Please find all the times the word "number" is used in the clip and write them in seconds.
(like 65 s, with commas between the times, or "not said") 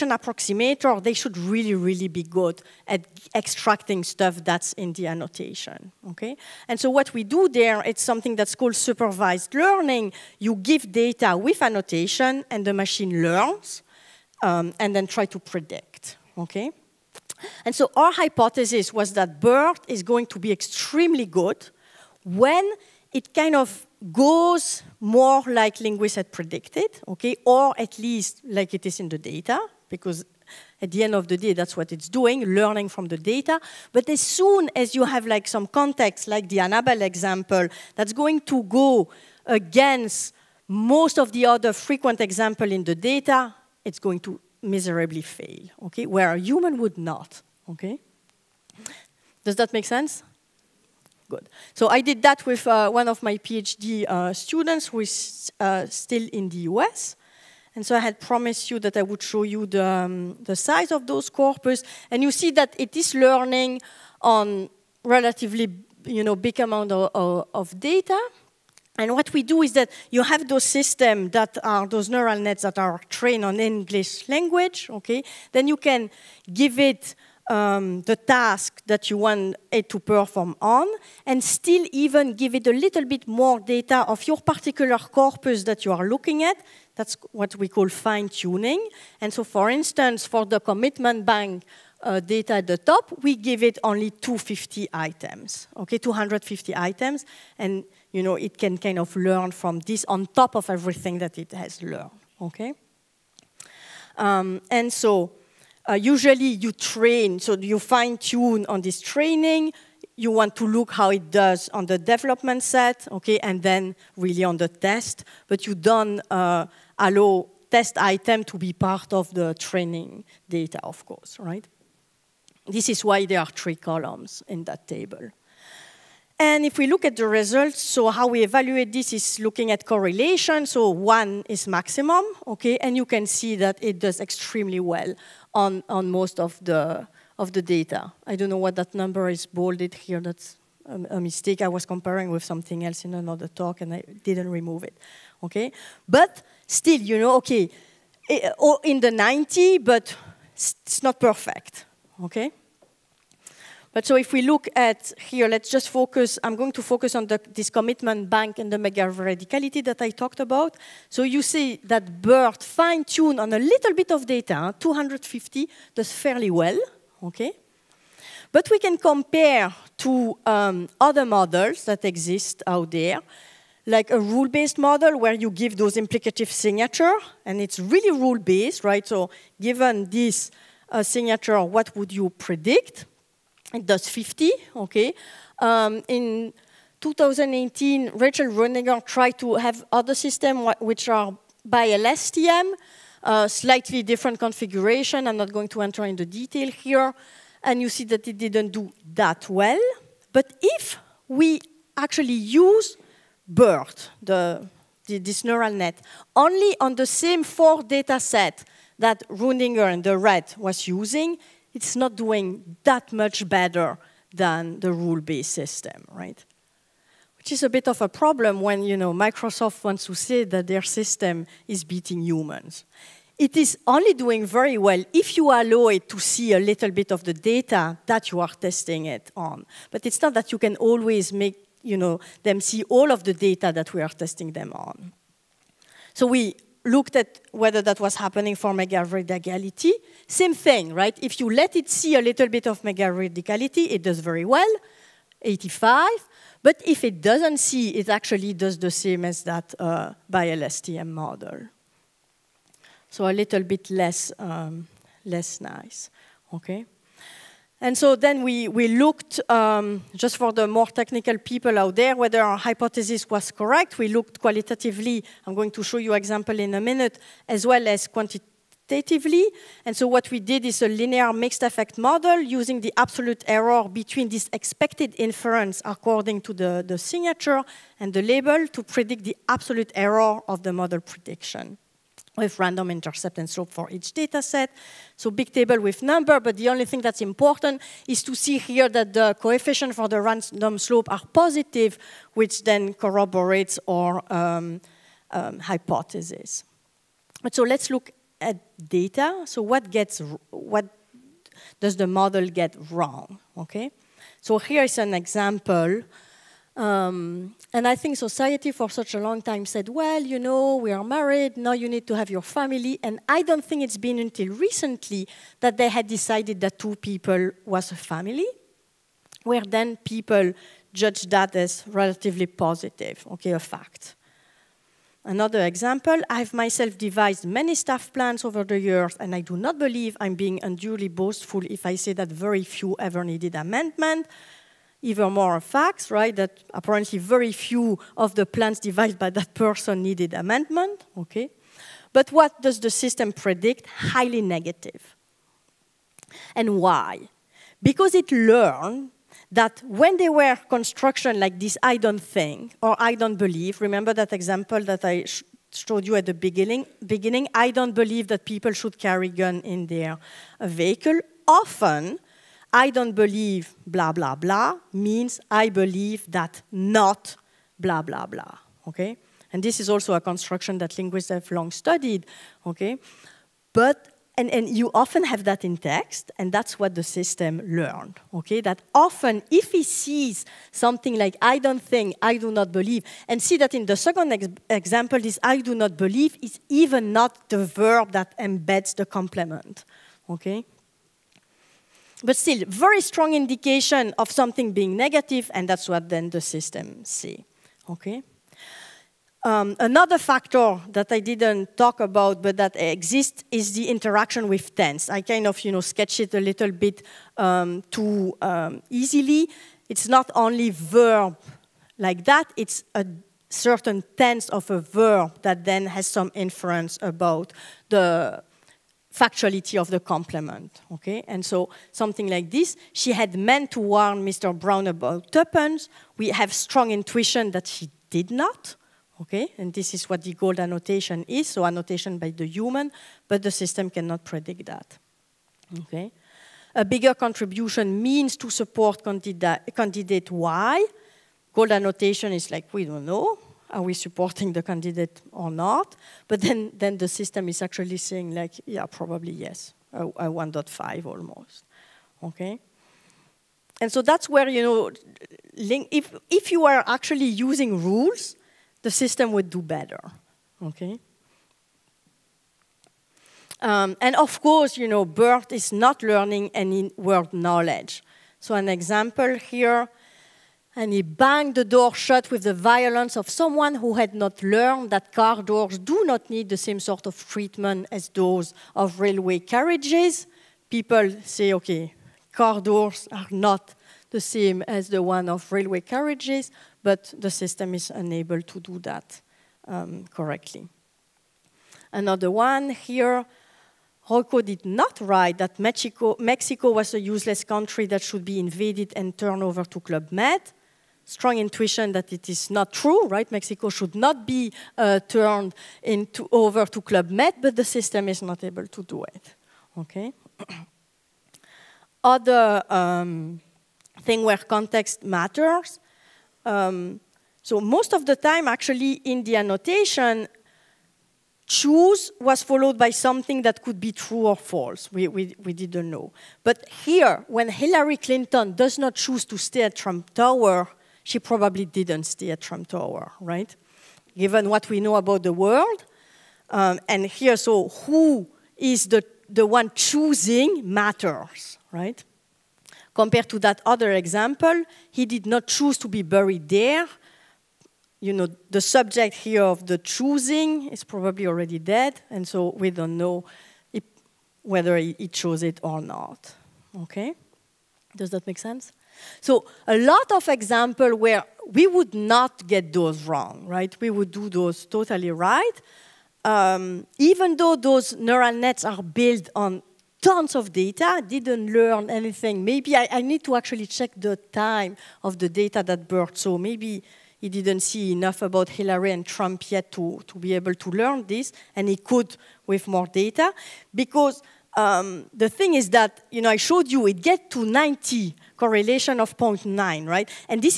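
138 s, 286 s.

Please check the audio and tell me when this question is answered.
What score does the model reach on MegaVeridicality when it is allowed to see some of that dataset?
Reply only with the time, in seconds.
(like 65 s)
245 s.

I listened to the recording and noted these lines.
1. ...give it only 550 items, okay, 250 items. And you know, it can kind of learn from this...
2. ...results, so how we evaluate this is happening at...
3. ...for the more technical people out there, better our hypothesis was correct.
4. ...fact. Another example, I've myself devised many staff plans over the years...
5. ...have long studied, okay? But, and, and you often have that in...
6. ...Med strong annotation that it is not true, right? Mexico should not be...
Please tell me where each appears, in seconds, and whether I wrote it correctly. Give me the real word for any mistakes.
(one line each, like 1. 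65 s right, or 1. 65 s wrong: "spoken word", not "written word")
1. 93 s wrong: "250", not "550"
2. 127 s wrong: "looking", not "happening"
3. 260 s wrong: "whether", not "better"
4. 323 s right
5. 371 s right
6. 500 s wrong: "intuition", not "annotation".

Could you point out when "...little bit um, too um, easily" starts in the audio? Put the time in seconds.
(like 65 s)
406 s.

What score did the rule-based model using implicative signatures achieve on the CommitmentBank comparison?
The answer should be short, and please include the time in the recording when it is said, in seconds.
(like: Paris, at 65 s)
50, at 183 s.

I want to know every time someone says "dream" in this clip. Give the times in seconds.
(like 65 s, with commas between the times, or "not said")
not said.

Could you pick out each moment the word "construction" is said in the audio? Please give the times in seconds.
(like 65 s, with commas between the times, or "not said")
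350 s, 370 s.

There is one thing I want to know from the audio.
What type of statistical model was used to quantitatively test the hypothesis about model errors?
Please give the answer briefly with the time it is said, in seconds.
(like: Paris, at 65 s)
linear mixed effect model, at 270 s.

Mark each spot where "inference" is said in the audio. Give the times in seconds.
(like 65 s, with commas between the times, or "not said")
275 s, 416 s.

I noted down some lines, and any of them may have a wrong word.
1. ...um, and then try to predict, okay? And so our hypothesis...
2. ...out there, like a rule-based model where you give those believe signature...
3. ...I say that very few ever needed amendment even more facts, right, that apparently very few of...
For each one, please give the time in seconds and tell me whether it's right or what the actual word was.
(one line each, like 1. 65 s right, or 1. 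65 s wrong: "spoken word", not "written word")
1. 14 s right
2. 172 s wrong: "implicative", not "believe"
3. 331 s right.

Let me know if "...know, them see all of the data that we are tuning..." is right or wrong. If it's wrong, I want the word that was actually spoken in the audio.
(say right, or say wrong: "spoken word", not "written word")
wrong: "testing", not "tuning".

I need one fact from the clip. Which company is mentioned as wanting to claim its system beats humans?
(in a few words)
Microsoft.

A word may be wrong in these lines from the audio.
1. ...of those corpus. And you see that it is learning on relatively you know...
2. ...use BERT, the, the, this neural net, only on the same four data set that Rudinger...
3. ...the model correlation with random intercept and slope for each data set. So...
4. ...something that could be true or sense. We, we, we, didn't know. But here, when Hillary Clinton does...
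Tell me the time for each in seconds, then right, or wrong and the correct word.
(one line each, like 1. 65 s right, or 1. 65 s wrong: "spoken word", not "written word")
1. 60 s right
2. 202 s right
3. 280 s wrong: "prediction", not "correlation"
4. 522 s wrong: "false", not "sense".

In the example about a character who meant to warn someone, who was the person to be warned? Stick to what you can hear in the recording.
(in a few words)
Mr. Brown.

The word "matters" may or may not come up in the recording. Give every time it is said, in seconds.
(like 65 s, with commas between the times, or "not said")
515 s, 540 s.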